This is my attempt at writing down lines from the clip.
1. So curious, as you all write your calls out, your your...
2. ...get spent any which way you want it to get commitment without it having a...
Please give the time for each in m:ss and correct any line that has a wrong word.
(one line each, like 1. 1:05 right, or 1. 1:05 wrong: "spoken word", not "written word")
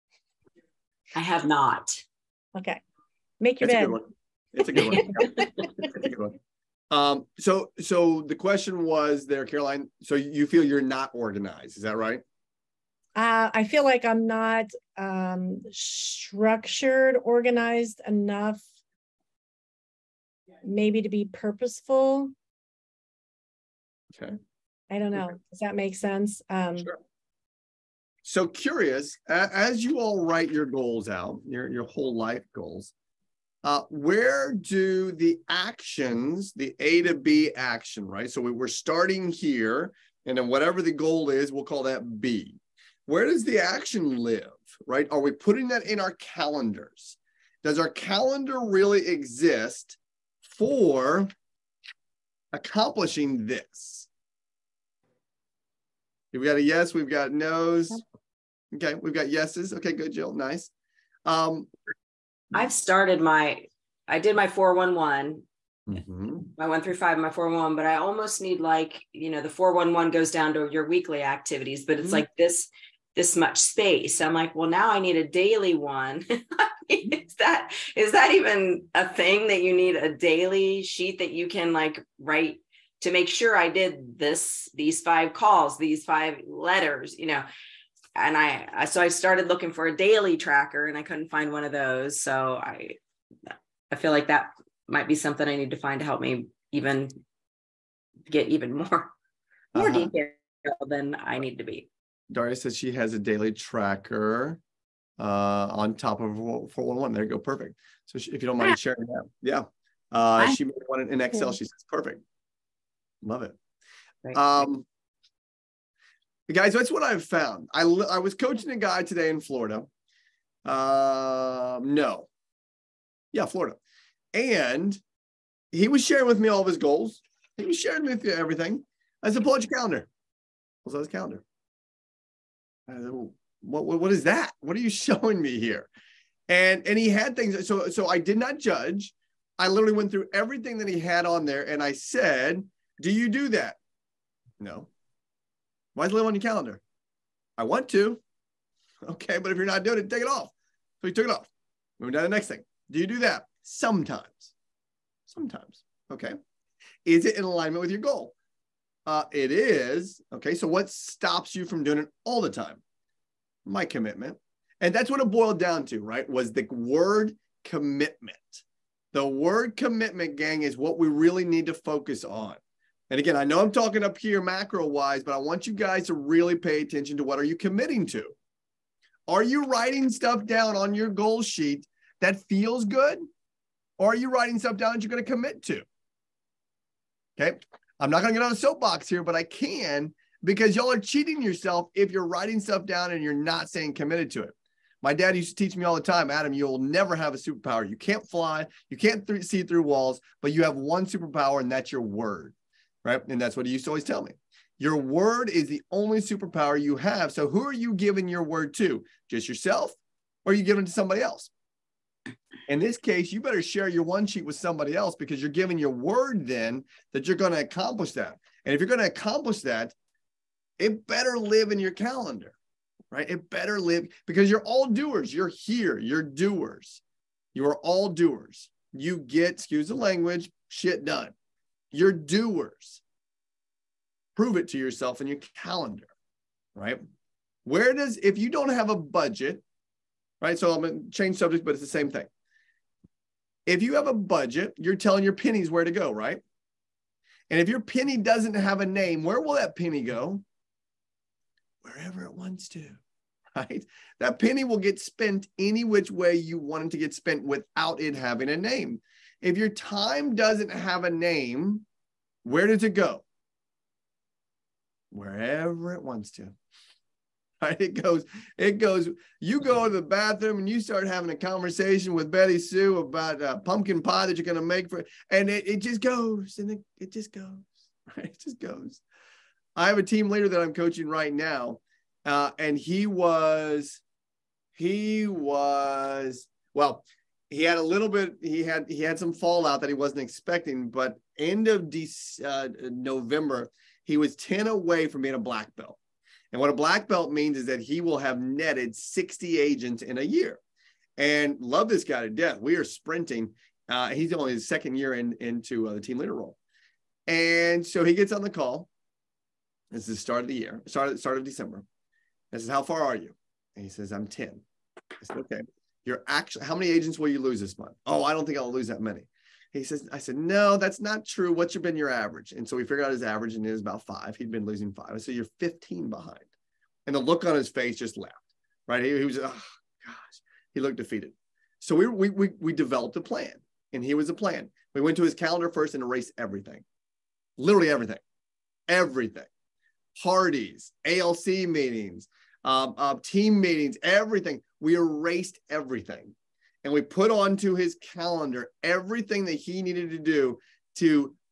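1. 0:28 wrong: "goals", not "calls"
2. 4:14 wrong: "spent", not "commitment".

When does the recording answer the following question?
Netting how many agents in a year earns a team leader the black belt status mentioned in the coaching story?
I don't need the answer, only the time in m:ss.
4:58.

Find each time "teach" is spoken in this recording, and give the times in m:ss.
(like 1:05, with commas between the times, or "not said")
3:15.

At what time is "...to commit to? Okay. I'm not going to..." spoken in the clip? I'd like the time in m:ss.
3:05.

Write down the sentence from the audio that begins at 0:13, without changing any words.
Uh, I feel like I'm not um, structured, organized enough, maybe to be purposeful.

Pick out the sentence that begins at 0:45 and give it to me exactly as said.
Are we putting that in our calendars?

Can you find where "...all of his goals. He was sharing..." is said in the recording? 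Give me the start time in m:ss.
2:06.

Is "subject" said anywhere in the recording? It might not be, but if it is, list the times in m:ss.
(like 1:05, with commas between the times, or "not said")
4:01.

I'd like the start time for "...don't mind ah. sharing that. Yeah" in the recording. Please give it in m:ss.
1:48.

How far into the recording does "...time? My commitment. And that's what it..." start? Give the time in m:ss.
2:42.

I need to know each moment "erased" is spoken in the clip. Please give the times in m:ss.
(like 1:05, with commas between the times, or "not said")
5:36, 5:44.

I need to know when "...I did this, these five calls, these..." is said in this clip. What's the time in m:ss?
1:23.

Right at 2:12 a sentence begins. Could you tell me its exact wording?
I said, what, what, what is that?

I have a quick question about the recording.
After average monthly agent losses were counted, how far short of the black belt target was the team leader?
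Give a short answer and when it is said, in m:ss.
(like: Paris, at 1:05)
15, at 5:25.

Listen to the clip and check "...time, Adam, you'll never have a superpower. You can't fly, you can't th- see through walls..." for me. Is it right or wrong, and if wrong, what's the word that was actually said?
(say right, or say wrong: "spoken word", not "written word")
right.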